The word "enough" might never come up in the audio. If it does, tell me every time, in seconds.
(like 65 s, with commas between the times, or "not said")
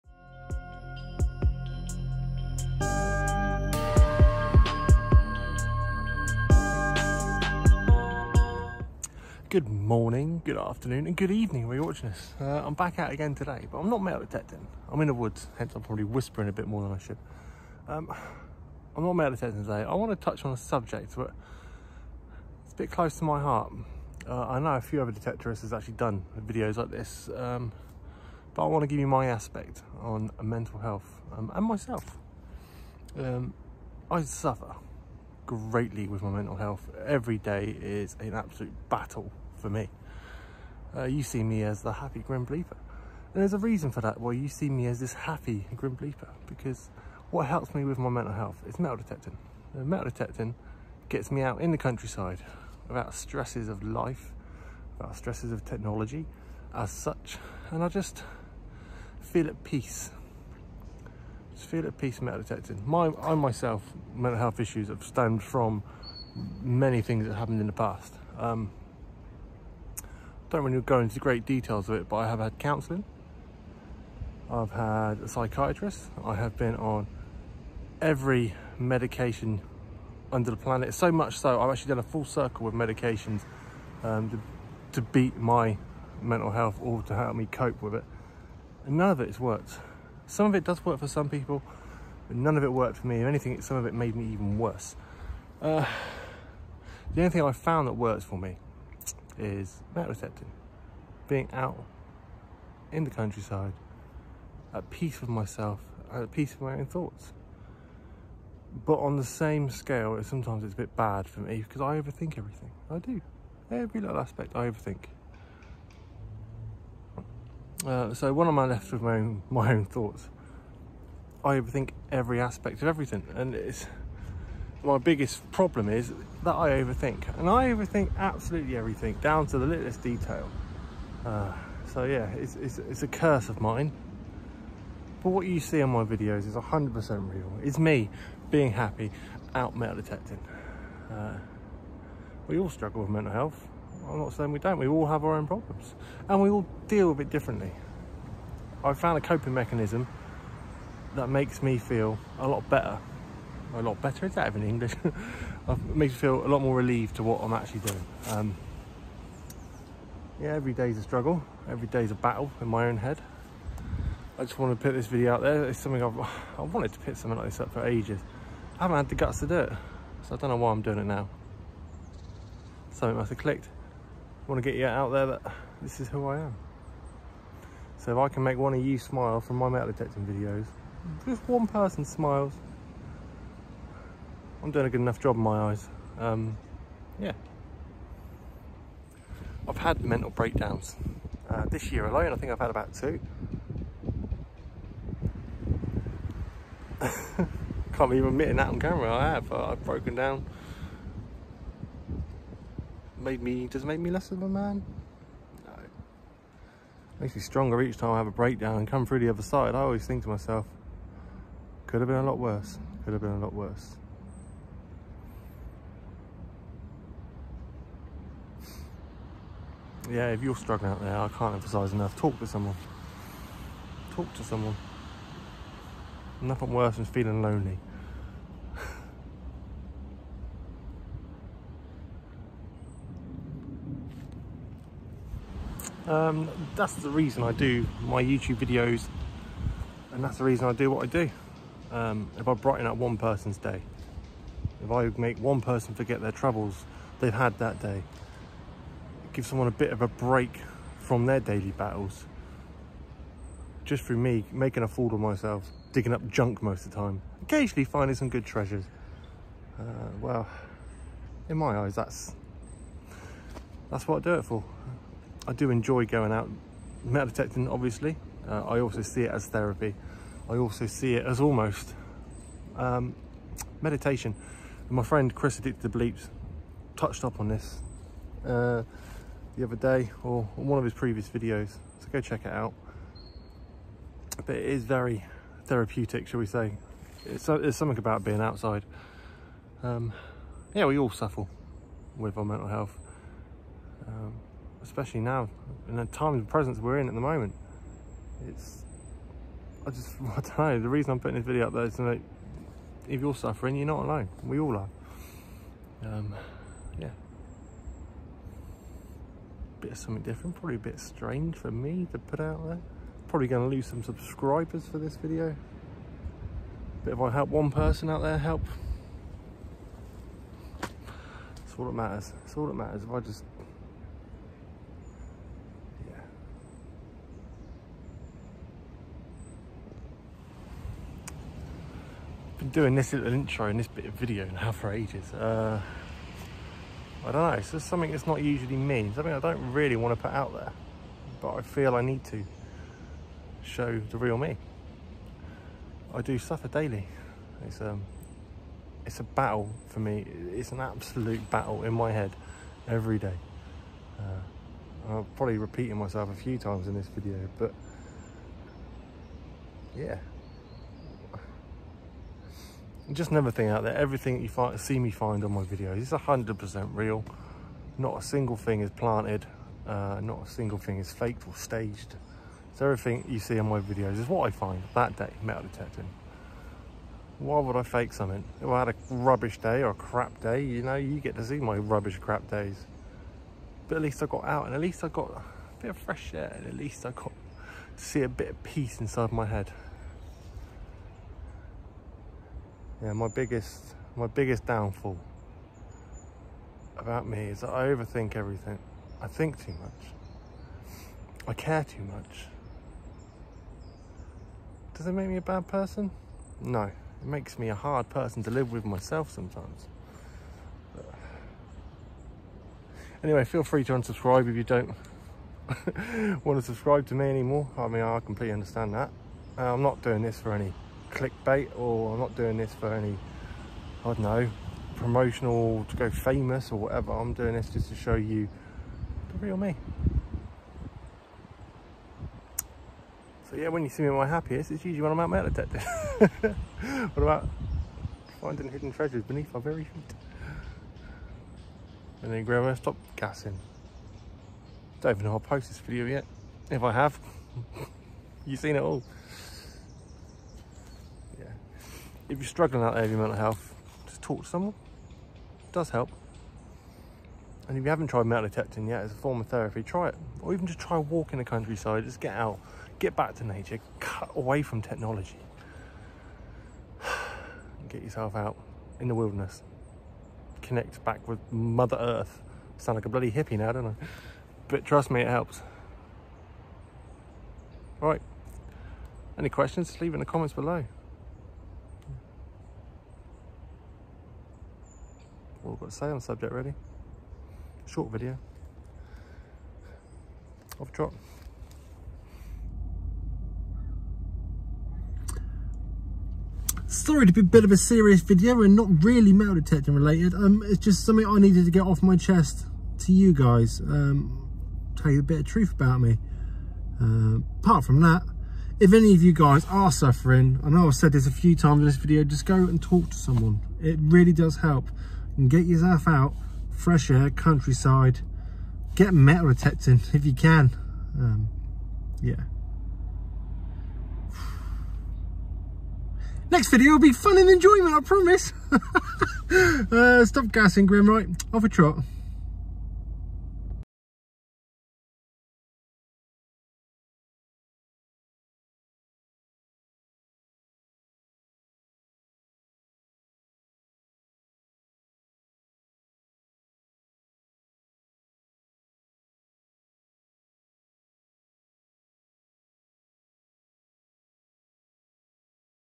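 184 s, 221 s.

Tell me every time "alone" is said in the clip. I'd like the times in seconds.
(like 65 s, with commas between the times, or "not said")
192 s, 304 s.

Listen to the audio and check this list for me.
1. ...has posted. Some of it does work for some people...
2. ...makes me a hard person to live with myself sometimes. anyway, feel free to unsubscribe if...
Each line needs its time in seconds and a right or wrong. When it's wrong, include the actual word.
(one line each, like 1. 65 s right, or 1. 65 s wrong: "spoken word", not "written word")
1. 89 s wrong: "worked", not "posted"
2. 407 s right.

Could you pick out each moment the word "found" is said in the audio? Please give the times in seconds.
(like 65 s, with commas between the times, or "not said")
97 s, 148 s.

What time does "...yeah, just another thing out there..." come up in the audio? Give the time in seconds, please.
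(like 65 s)
359 s.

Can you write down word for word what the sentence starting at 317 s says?
But if I help one person out there, help.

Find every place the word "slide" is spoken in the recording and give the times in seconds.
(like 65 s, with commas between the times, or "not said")
not said.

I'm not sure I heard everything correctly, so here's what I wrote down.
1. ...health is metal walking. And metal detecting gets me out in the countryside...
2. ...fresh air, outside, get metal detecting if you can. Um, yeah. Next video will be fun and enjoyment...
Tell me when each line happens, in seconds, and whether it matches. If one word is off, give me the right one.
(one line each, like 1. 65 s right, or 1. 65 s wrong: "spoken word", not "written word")
1. 48 s wrong: "detecting", not "walking"
2. 516 s wrong: "countryside", not "outside".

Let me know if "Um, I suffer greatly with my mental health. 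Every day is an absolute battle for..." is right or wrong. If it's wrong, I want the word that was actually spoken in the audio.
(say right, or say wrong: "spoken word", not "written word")
right.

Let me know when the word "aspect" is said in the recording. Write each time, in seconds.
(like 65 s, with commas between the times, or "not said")
29 s, 114 s, 122 s.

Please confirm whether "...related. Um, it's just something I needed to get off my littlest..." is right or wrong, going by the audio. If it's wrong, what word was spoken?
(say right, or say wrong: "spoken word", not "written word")
wrong: "chest", not "littlest".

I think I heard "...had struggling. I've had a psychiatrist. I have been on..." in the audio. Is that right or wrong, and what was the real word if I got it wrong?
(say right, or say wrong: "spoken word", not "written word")
wrong: "counselling", not "struggling".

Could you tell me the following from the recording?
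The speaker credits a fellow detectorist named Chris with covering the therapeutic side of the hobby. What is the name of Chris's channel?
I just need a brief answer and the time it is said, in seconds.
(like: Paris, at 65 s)
Addicted to Bleeps, at 275 s.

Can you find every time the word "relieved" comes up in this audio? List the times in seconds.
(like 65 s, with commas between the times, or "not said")
156 s.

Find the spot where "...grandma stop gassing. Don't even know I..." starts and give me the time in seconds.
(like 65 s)
442 s.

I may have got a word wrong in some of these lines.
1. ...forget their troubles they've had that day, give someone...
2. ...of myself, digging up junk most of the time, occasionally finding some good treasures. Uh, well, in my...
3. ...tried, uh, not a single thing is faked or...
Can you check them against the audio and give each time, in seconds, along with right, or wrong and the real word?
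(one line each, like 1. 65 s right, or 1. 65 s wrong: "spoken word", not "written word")
1. 245 s right
2. 255 s right
3. 368 s wrong: "planted", not "tried".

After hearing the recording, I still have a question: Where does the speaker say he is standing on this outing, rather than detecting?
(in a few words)
the woods.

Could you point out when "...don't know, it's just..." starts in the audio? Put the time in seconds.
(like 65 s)
337 s.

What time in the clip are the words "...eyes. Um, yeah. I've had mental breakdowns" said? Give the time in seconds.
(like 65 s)
185 s.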